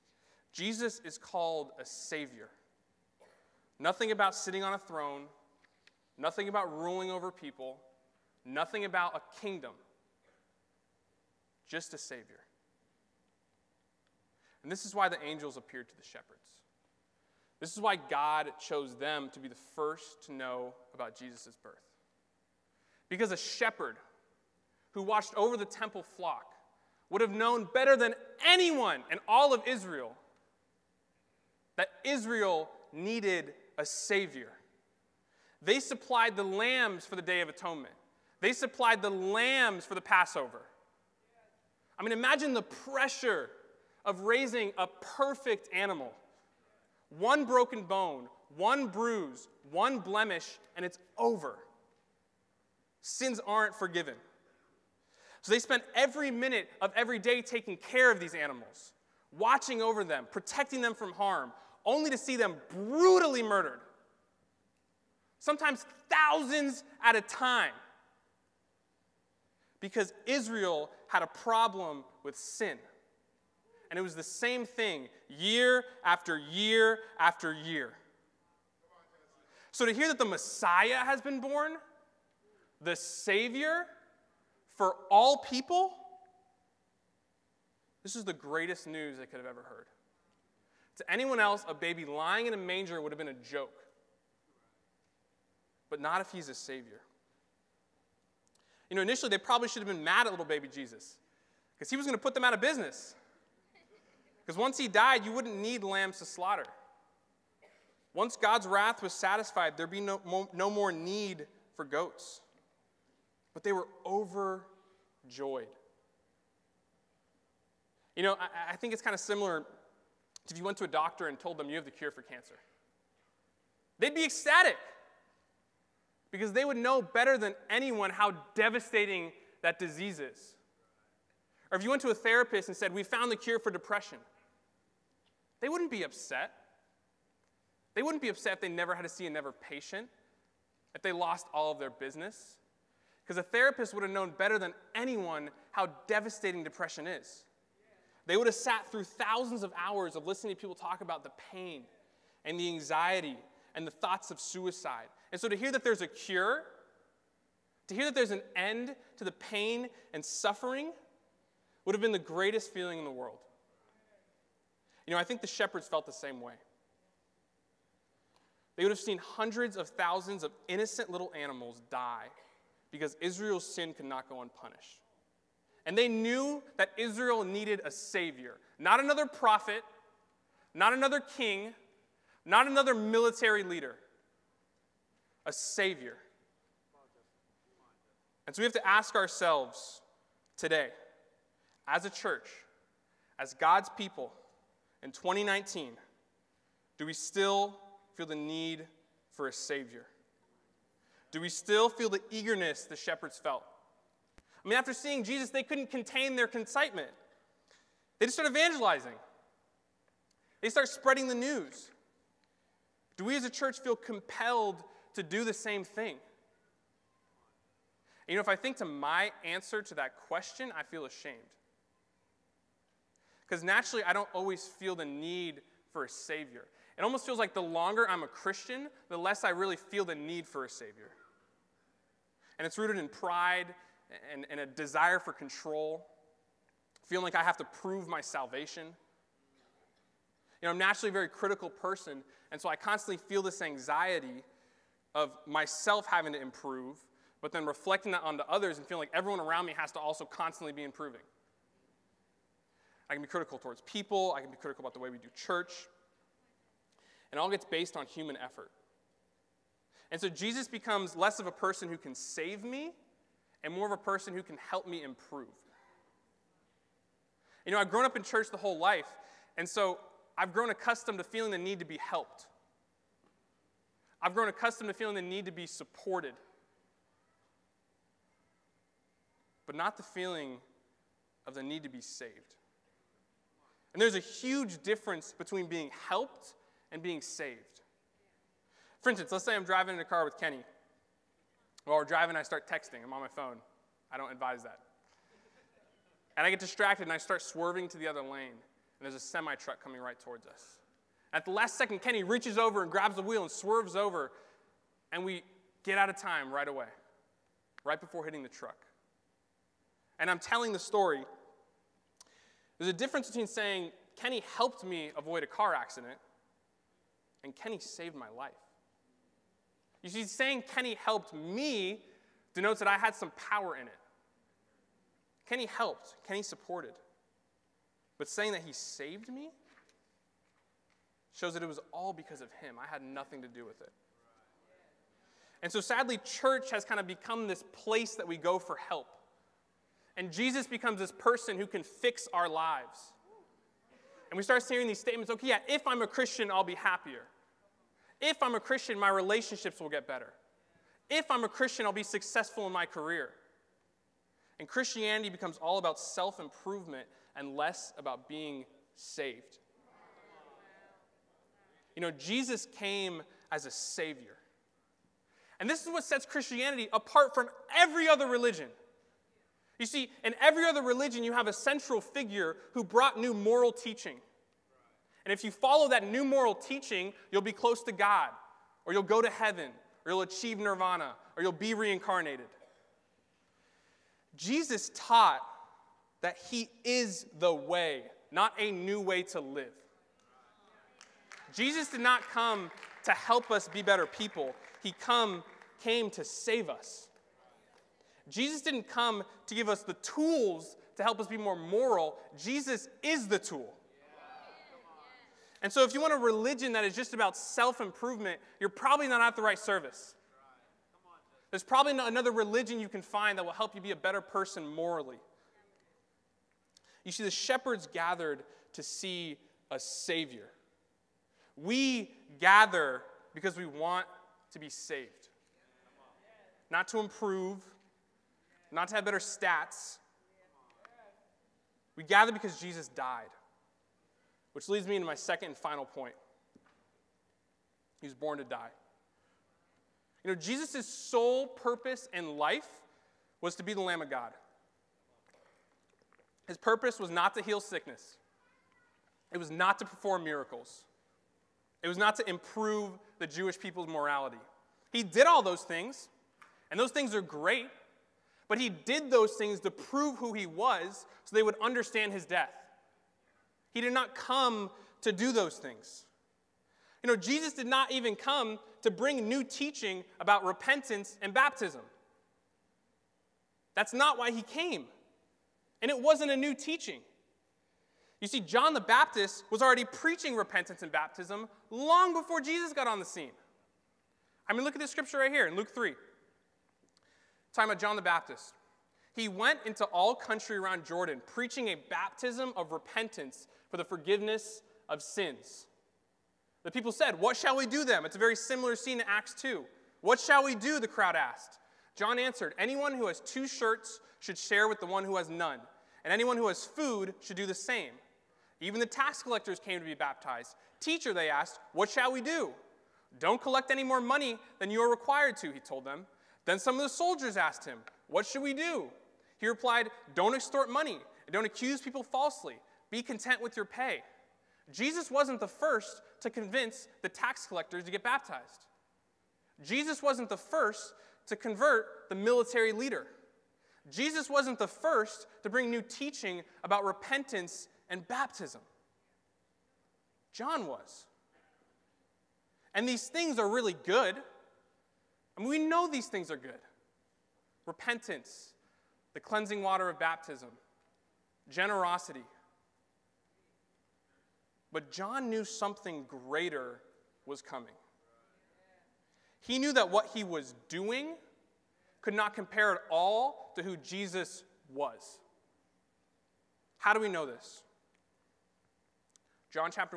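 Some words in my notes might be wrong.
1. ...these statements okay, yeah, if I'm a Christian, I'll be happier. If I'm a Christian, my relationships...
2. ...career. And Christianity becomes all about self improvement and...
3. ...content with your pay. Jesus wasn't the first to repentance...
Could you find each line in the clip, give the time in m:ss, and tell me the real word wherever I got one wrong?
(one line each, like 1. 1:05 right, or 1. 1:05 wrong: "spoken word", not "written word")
1. 5:44 right
2. 5:52 right
3. 8:43 wrong: "convince", not "repentance".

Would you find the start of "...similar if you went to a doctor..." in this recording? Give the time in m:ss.
1:59.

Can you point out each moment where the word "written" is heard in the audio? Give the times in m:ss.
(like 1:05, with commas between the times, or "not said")
not said.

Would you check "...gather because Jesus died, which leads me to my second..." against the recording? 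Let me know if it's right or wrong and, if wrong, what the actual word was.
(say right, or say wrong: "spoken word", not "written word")
right.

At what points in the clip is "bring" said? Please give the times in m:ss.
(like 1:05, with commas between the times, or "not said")
7:48, 8:55.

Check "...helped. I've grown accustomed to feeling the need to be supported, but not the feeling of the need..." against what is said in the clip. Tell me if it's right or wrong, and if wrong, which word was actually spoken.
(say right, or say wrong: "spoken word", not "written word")
right.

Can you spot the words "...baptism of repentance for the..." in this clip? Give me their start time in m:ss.
8:11.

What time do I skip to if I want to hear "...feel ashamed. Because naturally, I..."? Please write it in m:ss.
3:40.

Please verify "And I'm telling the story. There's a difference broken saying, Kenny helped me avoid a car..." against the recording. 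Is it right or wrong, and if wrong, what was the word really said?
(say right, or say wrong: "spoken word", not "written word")
wrong: "between", not "broken".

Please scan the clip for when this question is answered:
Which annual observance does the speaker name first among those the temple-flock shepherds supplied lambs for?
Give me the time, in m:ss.
0:37.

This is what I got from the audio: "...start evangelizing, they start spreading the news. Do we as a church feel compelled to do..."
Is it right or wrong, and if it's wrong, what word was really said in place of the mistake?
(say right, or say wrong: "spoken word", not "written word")
right.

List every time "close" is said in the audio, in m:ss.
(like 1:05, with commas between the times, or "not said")
6:17.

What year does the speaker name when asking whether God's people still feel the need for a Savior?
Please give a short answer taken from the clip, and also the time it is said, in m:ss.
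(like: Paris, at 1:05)
2019, at 3:15.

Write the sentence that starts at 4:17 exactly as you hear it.
And all gets based on human effort.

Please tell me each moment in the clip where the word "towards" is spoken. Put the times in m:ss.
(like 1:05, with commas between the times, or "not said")
4:13, 5:00.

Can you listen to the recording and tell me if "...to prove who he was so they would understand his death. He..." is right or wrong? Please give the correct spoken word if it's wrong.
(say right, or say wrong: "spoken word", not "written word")
right.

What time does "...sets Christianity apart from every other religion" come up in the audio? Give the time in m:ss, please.
6:06.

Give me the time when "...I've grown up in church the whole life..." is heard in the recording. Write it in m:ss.
4:27.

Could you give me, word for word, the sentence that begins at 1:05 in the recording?
Sometimes thousands at a time because Israel had a problem with sin.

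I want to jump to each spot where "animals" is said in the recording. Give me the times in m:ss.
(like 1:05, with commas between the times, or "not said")
0:45, 0:58, 2:51.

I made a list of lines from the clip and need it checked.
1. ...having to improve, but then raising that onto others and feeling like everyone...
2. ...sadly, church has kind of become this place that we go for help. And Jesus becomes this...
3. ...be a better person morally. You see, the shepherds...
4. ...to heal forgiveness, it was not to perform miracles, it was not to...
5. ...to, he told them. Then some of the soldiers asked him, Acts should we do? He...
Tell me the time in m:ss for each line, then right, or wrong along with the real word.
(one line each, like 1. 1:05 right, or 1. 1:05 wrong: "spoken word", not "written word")
1. 4:06 wrong: "reflecting", not "raising"
2. 5:35 right
3. 6:53 right
4. 7:27 wrong: "sickness", not "forgiveness"
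5. 8:35 wrong: "What", not "Acts".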